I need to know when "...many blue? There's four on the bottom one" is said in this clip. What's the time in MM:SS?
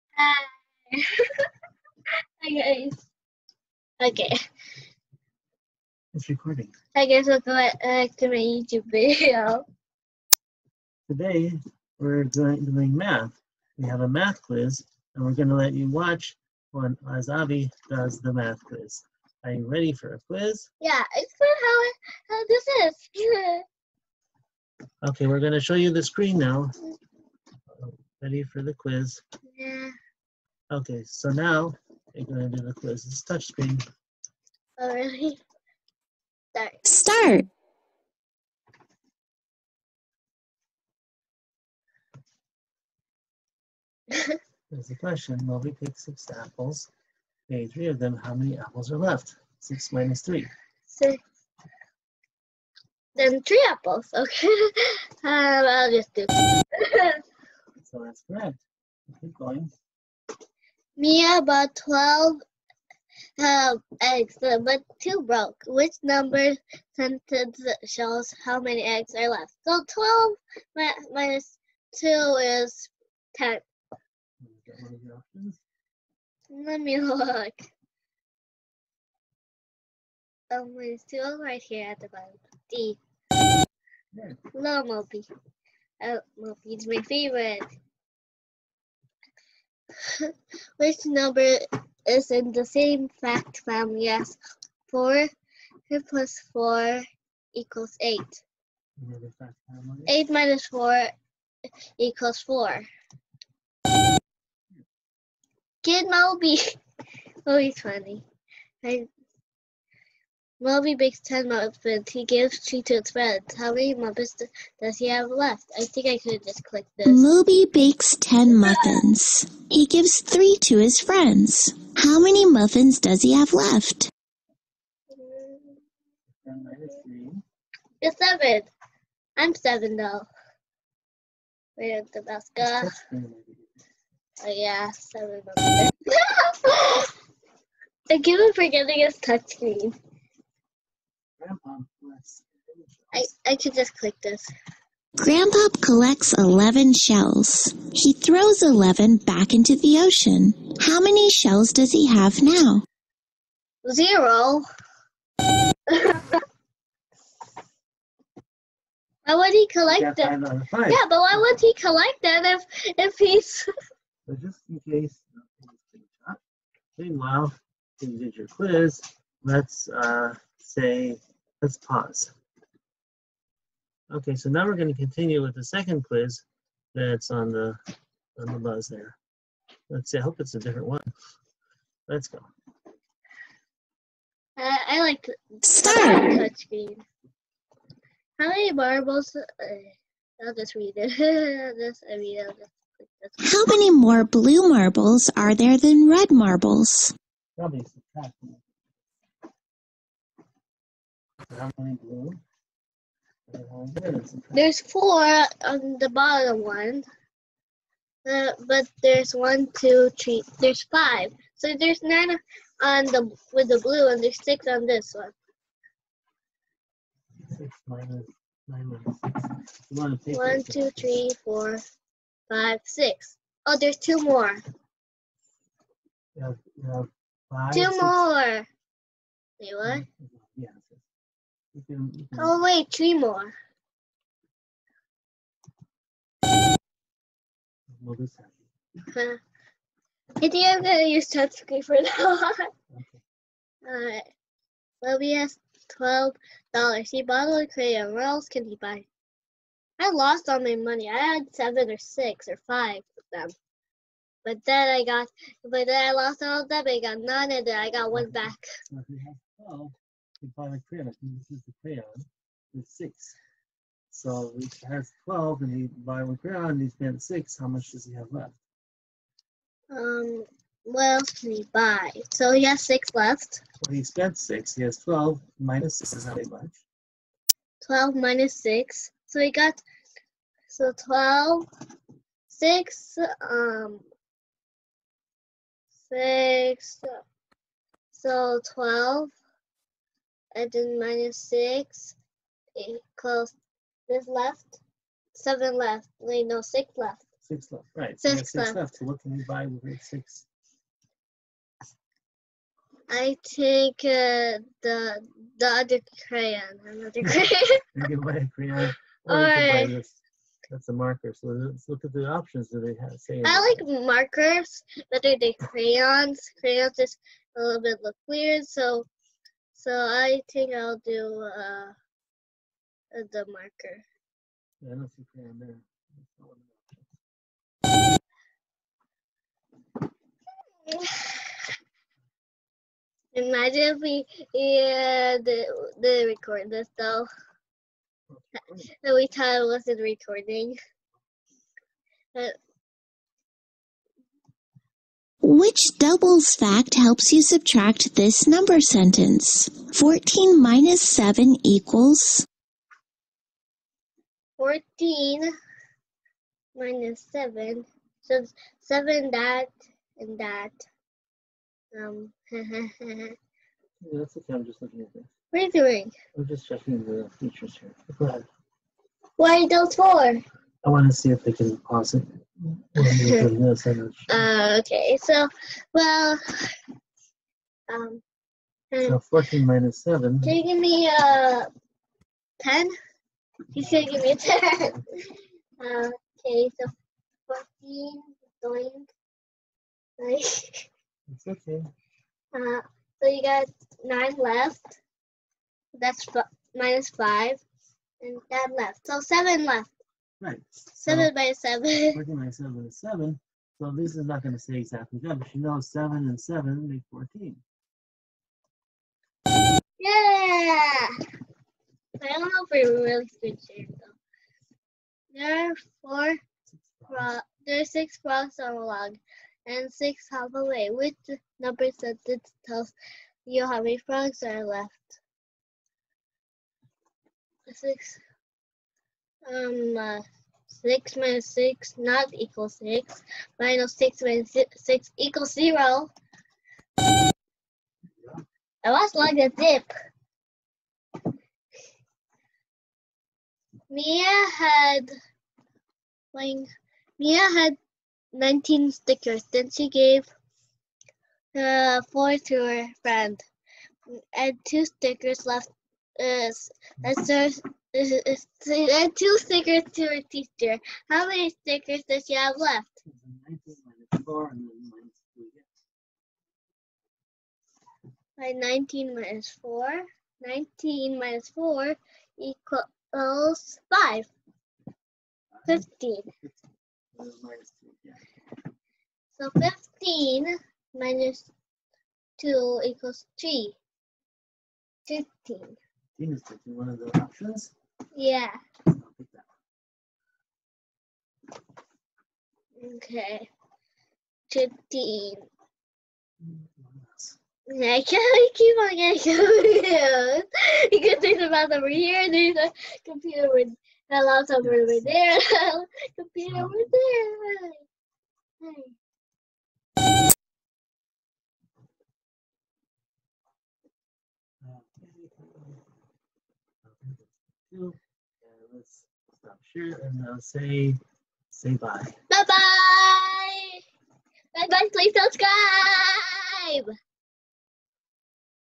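03:21.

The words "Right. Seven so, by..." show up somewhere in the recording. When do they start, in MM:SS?
06:40.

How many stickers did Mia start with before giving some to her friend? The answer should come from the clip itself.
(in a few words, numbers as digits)
19.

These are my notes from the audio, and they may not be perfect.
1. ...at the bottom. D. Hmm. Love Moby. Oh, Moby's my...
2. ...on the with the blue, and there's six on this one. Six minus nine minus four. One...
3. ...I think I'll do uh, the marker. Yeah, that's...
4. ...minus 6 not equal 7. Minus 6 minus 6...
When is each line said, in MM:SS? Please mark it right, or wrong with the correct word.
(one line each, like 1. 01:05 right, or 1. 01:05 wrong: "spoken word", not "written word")
1. 01:21 right
2. 03:32 wrong: "six", not "four"
3. 05:19 right
4. 07:11 wrong: "6", not "7".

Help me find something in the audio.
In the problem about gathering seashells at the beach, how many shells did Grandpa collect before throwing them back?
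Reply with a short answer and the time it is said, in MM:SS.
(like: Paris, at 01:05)
11, at 02:25.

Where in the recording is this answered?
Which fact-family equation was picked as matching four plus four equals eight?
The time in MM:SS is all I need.
01:40.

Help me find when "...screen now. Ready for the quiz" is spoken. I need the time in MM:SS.
00:26.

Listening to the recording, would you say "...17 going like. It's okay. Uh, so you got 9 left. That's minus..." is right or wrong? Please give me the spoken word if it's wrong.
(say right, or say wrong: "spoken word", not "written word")
wrong: "14", not "17".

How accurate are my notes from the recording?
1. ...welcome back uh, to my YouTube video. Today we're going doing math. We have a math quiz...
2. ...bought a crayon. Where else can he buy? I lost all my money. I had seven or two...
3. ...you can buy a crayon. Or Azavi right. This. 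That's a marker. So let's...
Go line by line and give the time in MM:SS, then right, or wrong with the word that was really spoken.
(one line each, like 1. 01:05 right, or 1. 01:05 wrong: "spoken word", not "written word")
1. 00:07 right
2. 04:07 wrong: "six", not "two"
3. 05:07 wrong: "All", not "Azavi".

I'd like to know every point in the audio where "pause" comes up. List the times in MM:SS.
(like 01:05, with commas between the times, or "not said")
02:51, 06:11.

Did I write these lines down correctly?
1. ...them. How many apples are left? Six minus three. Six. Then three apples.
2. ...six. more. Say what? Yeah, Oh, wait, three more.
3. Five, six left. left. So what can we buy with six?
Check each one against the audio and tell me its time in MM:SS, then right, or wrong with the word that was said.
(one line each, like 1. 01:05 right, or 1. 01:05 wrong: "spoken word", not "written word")
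1. 00:47 right
2. 03:47 right
3. 04:58 wrong: "Six", not "Five".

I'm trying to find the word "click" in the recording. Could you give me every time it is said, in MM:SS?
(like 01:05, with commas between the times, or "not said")
01:56, 02:23.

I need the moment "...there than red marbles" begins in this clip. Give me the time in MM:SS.
03:15.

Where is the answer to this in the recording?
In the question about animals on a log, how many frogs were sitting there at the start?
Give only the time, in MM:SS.
06:57.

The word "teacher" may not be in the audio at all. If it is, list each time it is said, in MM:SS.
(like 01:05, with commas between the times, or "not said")
07:40.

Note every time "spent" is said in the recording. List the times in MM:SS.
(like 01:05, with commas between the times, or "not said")
04:26, 04:34.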